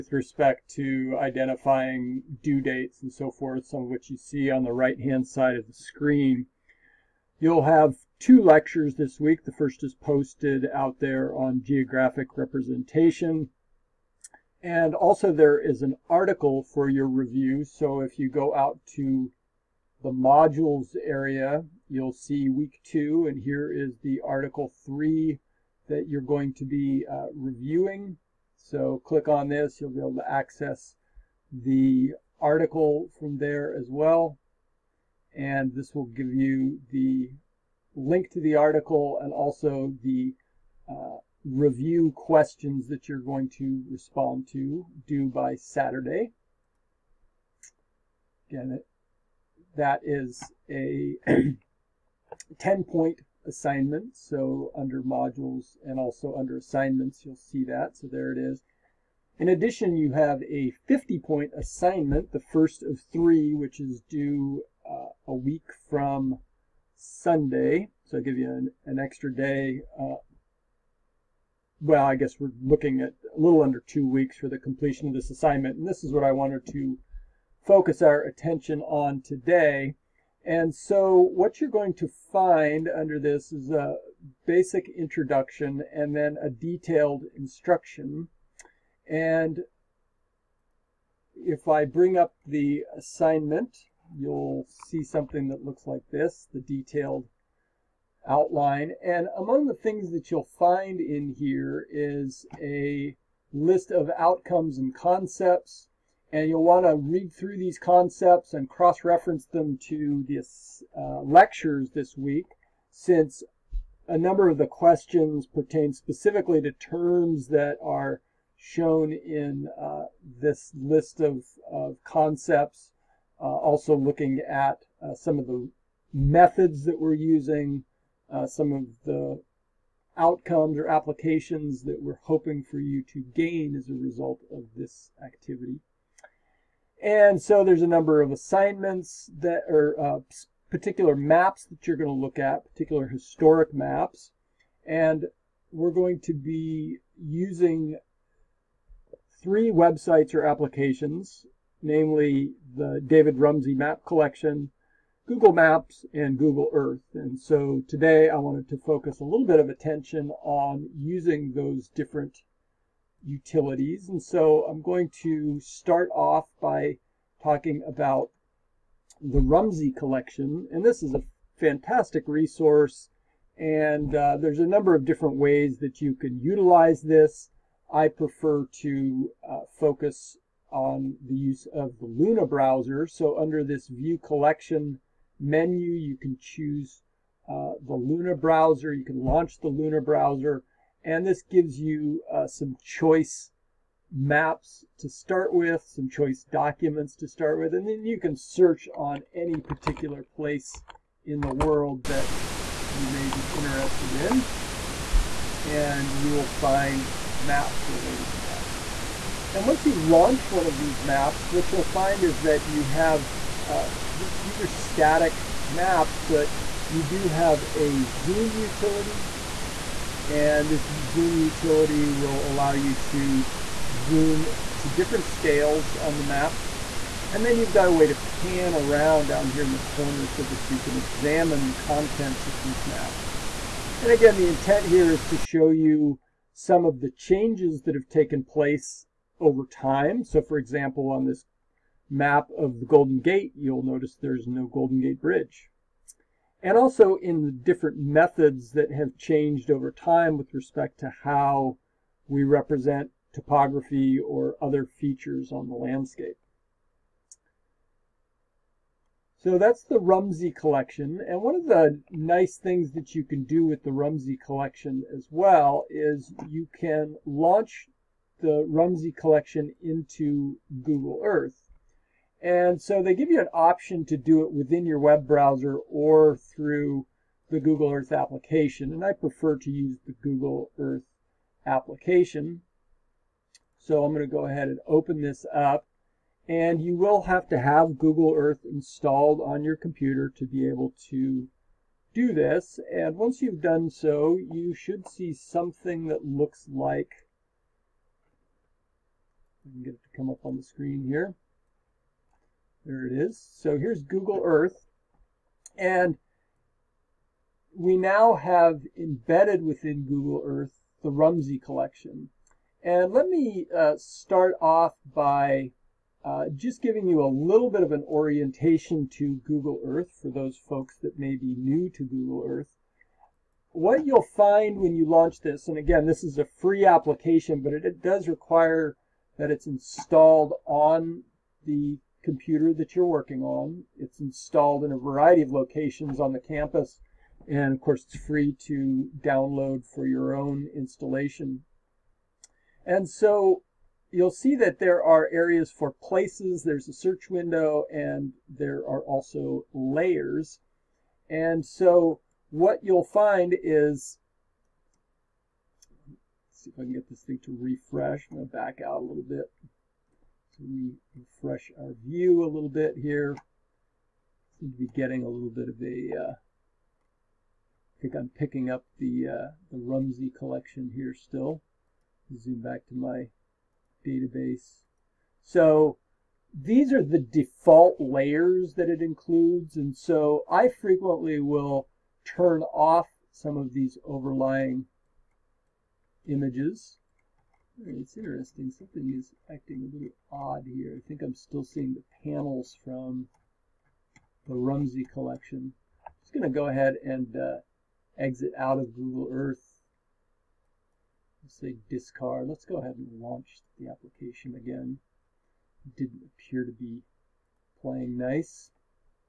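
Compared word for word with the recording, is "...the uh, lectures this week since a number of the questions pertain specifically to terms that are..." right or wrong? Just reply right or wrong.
right.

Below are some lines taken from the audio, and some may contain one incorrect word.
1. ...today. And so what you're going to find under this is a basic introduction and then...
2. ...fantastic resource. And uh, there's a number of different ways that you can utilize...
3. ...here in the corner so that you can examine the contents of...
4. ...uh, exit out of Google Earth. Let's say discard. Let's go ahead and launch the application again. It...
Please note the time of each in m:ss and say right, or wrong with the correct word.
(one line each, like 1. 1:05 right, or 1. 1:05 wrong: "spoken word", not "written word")
1. 1:19 right
2. 2:51 right
3. 3:49 right
4. 6:37 right.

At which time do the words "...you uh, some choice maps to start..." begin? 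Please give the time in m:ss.
3:11.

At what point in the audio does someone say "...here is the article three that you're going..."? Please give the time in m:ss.
0:23.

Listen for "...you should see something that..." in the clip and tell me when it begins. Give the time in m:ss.
4:54.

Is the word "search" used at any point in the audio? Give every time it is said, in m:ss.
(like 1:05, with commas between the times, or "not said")
3:18, 5:46.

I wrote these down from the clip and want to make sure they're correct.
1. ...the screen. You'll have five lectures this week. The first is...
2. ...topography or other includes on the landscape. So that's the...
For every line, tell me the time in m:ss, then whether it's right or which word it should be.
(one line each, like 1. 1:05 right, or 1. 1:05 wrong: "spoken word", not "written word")
1. 0:05 wrong: "two", not "five"
2. 4:13 wrong: "features", not "includes".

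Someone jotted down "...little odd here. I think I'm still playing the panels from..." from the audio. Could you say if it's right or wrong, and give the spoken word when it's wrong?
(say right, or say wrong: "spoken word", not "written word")
wrong: "seeing", not "playing".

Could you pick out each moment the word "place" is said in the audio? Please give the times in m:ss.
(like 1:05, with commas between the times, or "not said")
3:20, 3:58, 5:46.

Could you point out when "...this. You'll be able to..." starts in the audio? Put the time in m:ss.
0:29.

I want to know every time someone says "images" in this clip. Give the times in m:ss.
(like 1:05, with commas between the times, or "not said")
6:26.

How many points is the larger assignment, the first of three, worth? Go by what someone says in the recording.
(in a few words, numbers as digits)
50.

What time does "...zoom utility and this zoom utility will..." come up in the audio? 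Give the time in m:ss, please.
3:38.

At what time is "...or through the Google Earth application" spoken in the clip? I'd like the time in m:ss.
4:35.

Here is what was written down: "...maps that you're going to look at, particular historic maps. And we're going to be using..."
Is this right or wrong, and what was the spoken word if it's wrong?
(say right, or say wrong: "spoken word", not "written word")
right.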